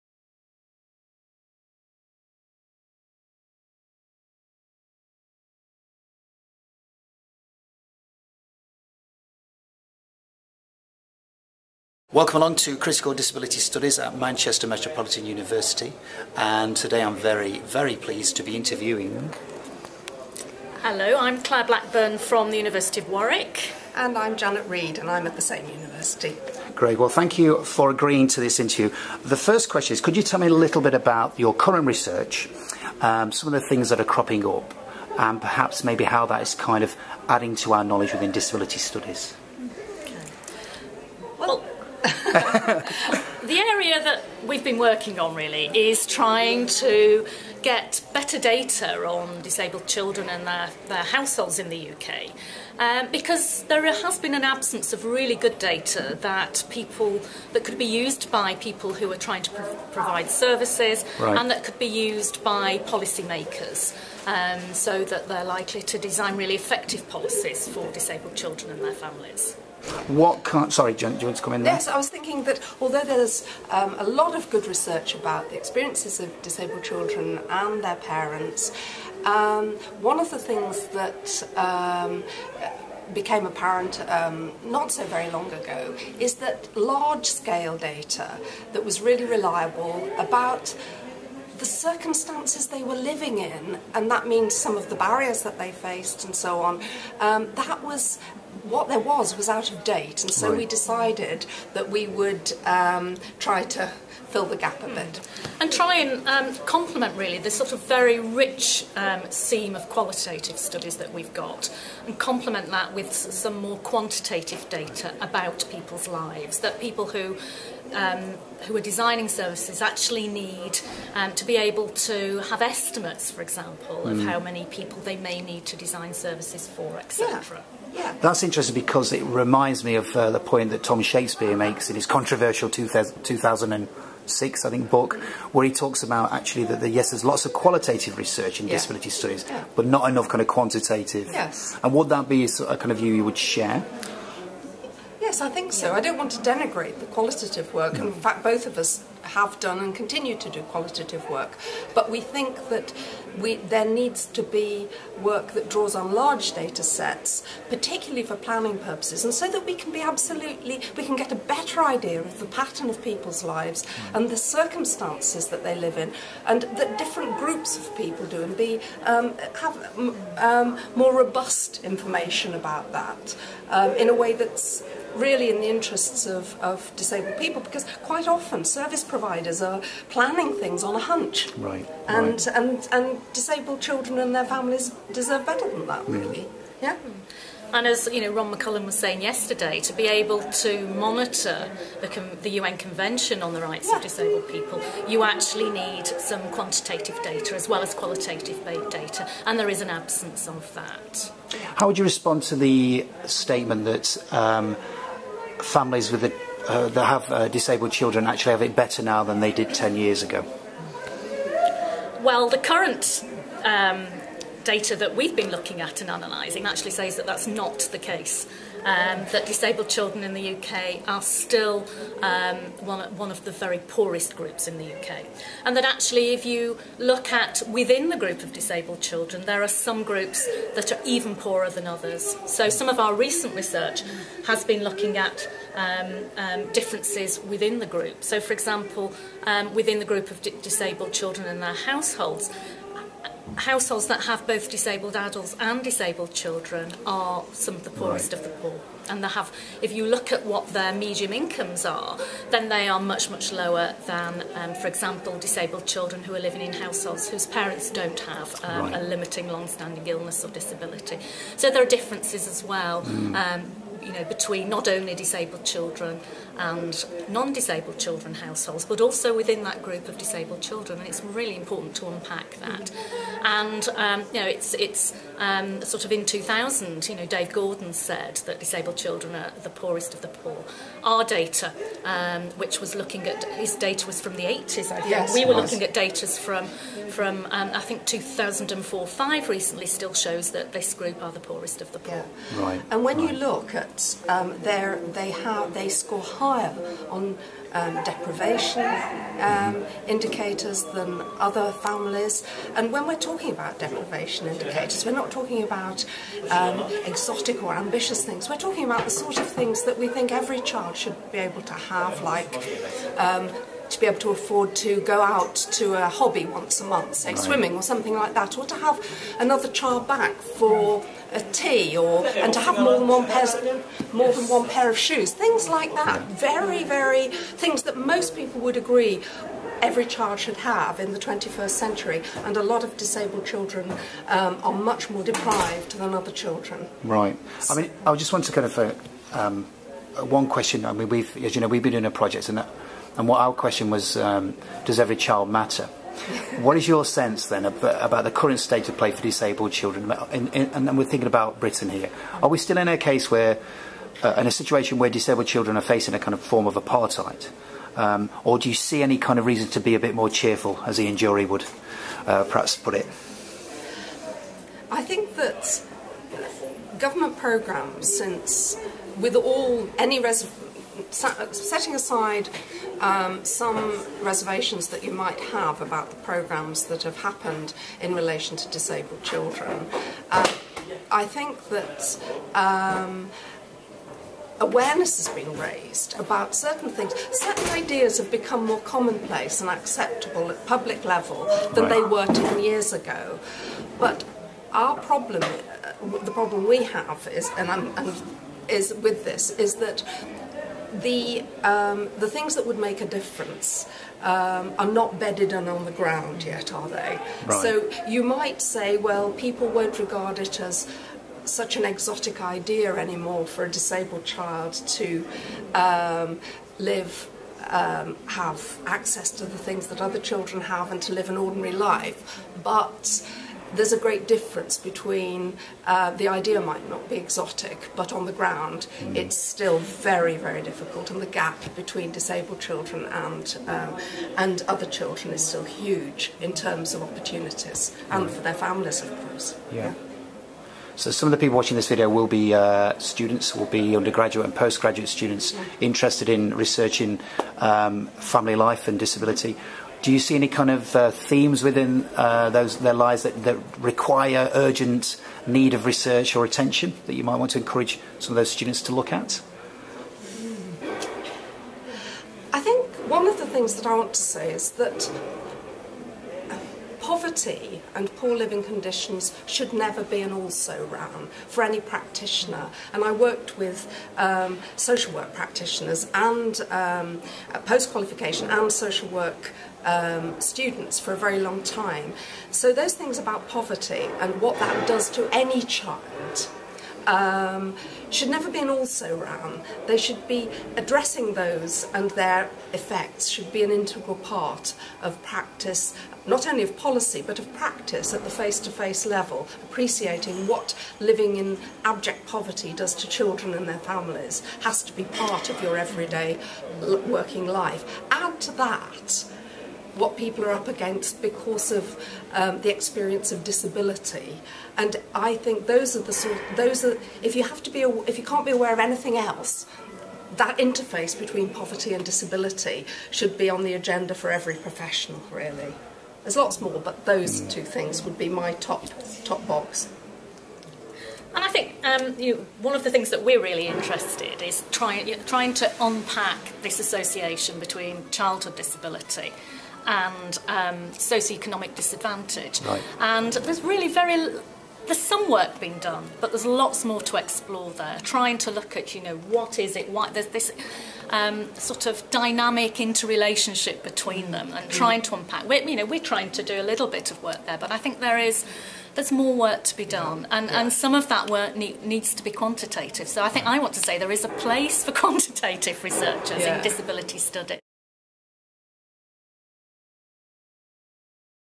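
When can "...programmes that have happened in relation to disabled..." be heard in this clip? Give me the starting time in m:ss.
6:16.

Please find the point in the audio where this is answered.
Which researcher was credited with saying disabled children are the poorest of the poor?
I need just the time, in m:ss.
4:37.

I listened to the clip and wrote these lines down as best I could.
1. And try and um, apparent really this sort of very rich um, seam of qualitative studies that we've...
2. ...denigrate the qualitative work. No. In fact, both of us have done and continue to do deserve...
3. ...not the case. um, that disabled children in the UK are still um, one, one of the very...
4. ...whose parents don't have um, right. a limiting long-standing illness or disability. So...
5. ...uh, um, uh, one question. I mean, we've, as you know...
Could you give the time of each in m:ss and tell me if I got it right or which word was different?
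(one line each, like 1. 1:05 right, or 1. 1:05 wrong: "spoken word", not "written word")
1. 1:45 wrong: "complement", not "apparent"
2. 2:26 wrong: "qualitative", not "deserve"
3. 3:37 right
4. 4:17 right
5. 5:38 right.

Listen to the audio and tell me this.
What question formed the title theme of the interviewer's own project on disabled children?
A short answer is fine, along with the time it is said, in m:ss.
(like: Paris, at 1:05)
Does every child matter?, at 5:44.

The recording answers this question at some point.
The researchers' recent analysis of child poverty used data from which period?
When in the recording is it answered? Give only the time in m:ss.
4:48.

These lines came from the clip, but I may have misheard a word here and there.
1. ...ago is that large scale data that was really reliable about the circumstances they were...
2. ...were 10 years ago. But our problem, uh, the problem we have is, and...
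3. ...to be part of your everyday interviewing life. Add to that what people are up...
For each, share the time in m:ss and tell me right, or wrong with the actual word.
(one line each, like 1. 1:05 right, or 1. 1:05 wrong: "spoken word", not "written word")
1. 1:25 right
2. 6:32 right
3. 8:24 wrong: "working", not "interviewing".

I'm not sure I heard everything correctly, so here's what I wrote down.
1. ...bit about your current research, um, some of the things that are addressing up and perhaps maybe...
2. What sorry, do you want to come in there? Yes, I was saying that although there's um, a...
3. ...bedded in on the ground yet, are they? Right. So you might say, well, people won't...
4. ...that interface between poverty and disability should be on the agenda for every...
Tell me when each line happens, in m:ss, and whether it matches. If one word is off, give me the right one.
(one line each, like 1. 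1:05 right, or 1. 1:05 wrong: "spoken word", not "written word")
1. 0:30 wrong: "cropping", not "addressing"
2. 1:10 wrong: "thinking", not "saying"
3. 6:45 right
4. 8:40 right.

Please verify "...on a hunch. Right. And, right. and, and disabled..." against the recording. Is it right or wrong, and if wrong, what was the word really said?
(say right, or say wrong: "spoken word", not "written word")
right.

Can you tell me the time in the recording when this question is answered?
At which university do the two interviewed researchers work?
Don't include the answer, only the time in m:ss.
0:22.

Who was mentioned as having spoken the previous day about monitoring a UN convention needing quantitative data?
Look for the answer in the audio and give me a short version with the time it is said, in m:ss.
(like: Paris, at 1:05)
Ron McCallum, at 3:08.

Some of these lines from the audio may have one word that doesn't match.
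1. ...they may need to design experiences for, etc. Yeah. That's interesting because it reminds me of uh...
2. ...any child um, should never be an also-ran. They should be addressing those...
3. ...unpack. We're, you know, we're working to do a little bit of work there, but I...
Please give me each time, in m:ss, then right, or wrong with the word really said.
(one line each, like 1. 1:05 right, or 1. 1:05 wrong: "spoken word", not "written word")
1. 2:05 wrong: "services", not "experiences"
2. 8:05 right
3. 9:15 wrong: "trying", not "working".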